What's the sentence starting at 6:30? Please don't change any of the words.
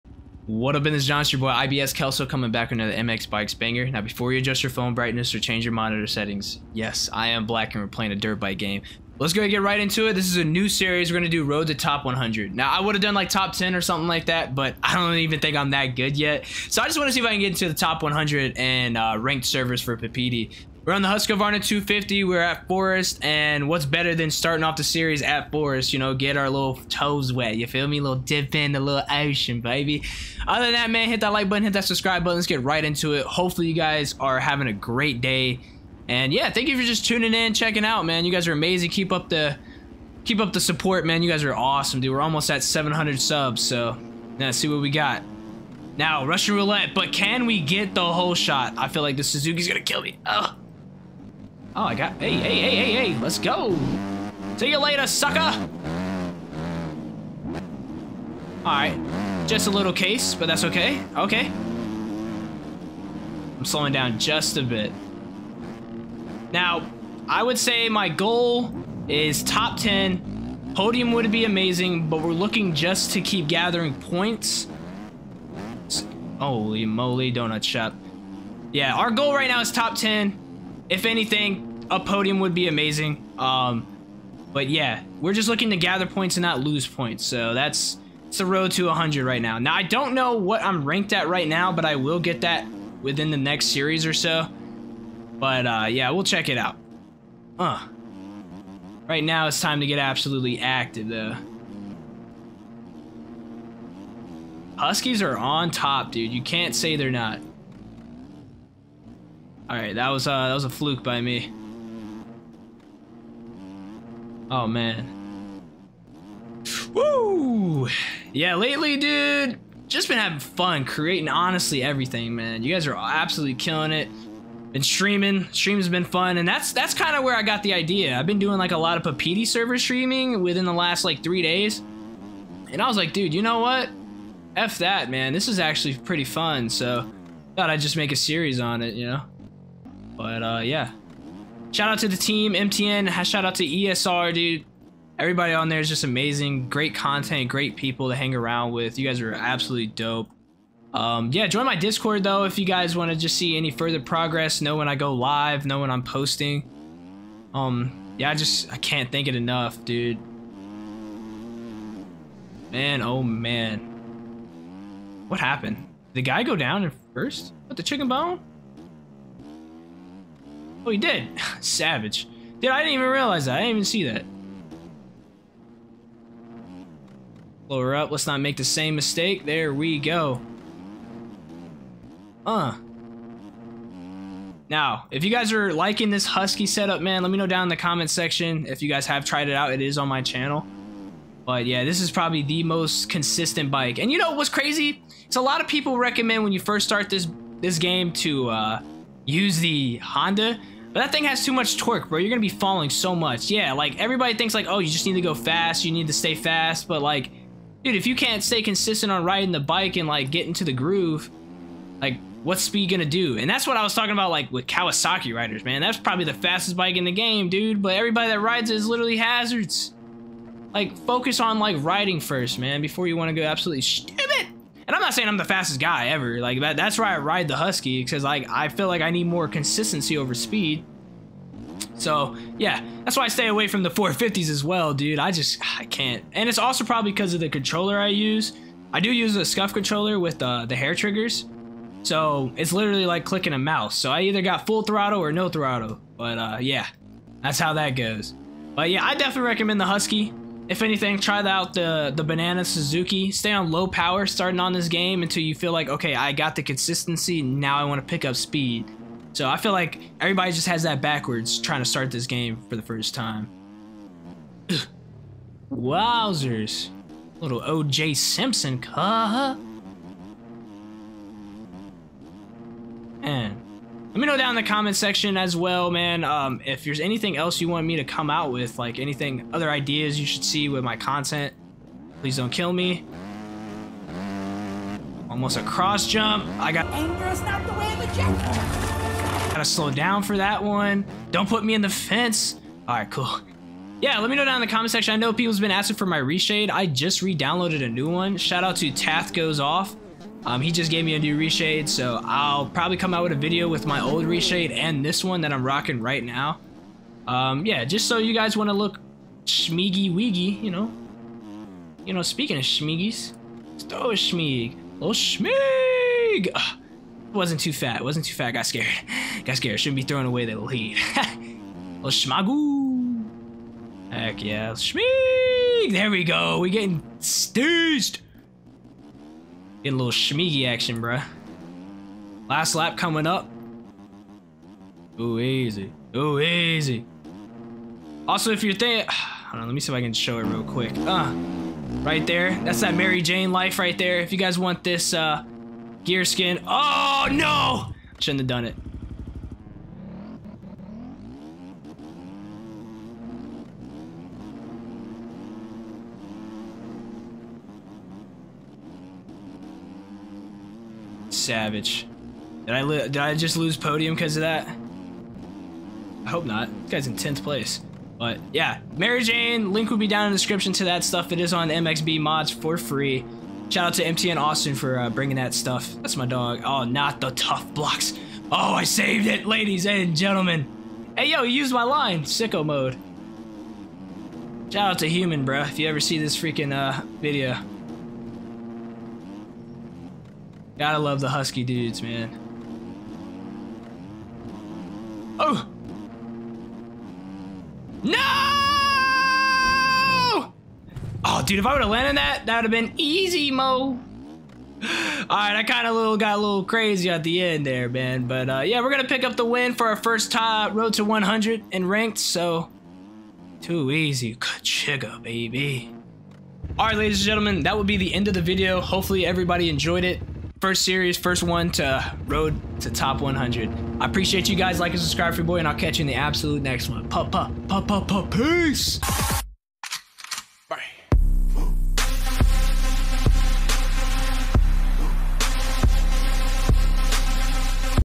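Gotta love the husky dudes, man.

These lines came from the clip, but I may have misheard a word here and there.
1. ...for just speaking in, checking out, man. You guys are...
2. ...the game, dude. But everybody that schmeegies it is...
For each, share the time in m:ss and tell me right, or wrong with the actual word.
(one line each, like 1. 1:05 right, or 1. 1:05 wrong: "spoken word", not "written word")
1. 0:36 wrong: "tuning", not "speaking"
2. 3:37 wrong: "rides", not "schmeegies".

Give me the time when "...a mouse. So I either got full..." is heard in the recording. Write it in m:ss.
4:03.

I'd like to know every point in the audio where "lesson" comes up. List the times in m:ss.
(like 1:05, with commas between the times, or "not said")
not said.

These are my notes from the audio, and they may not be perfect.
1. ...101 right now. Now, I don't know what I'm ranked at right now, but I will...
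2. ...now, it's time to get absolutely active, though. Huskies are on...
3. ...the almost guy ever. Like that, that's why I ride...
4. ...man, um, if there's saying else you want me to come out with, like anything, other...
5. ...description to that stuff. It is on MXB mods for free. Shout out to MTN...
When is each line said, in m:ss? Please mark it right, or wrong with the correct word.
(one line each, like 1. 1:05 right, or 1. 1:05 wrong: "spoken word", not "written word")
1. 1:28 wrong: "100", not "101"
2. 1:39 right
3. 3:45 wrong: "fastest", not "almost"
4. 4:35 wrong: "anything", not "saying"
5. 6:10 right.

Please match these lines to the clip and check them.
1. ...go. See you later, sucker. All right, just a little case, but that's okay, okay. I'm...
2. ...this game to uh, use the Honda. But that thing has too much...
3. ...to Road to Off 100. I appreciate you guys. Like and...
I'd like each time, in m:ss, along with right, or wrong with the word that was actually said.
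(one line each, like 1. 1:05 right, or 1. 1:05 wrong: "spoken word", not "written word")
1. 0:53 right
2. 3:17 right
3. 7:01 wrong: "Top", not "Off".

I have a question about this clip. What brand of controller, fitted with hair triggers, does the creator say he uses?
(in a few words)
SCUF.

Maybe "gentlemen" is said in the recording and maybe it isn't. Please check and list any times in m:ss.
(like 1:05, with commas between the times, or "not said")
6:20, 6:57.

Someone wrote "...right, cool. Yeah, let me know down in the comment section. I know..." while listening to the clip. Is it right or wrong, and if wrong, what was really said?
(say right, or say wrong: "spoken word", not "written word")
right.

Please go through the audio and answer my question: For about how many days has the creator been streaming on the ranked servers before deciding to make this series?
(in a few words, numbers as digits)
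3.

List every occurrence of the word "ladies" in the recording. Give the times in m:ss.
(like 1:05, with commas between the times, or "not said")
6:19, 6:56.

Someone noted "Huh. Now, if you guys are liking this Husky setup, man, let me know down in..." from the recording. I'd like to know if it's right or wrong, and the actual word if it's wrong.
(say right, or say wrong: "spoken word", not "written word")
right.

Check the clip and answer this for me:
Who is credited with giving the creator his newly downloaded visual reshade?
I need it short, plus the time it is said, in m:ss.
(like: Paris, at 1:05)
Tath Goes Off, at 4:58.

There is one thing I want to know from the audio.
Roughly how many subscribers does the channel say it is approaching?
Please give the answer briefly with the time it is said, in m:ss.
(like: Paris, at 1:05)
700, at 0:42.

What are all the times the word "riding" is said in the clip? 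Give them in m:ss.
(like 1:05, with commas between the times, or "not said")
3:29, 3:41.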